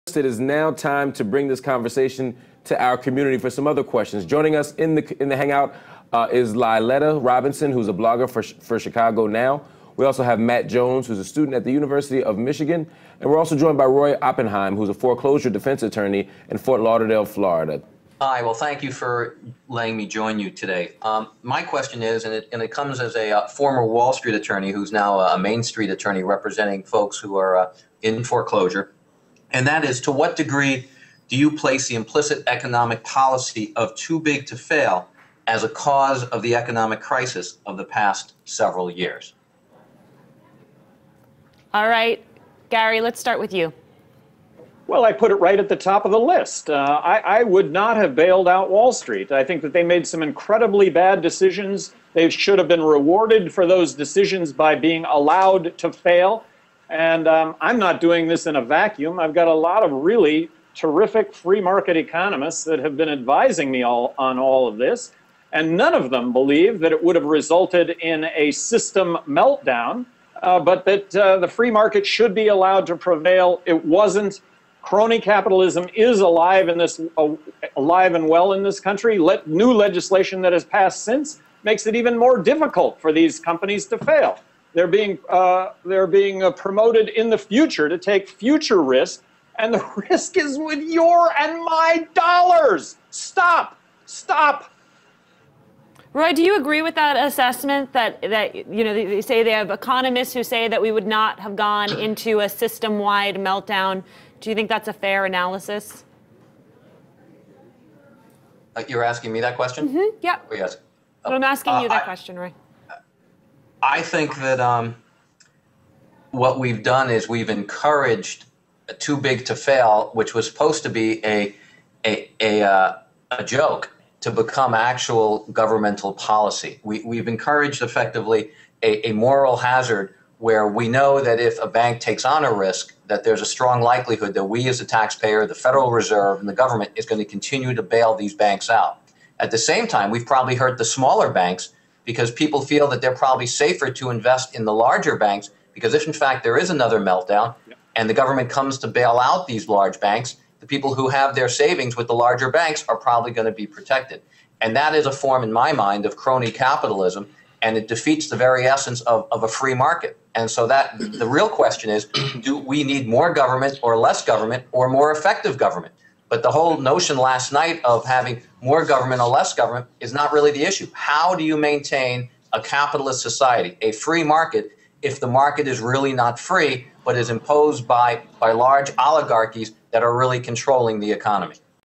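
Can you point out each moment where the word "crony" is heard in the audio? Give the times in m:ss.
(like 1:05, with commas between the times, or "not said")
1:14, 2:36.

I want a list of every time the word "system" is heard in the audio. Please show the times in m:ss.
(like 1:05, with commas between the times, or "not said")
1:08, 1:42.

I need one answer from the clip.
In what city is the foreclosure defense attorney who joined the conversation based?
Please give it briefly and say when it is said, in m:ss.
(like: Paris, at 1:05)
Fort Lauderdale, at 0:16.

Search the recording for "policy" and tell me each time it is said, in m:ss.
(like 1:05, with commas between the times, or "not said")
0:33, 2:06.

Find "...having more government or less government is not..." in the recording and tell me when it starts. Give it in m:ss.
2:48.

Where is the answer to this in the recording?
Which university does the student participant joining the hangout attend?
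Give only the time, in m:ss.
0:11.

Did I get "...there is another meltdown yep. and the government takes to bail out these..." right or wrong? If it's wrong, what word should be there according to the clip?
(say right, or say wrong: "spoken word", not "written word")
wrong: "comes", not "takes".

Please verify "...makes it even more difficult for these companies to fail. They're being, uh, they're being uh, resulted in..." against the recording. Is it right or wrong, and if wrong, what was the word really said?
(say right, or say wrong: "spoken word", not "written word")
wrong: "promoted", not "resulted".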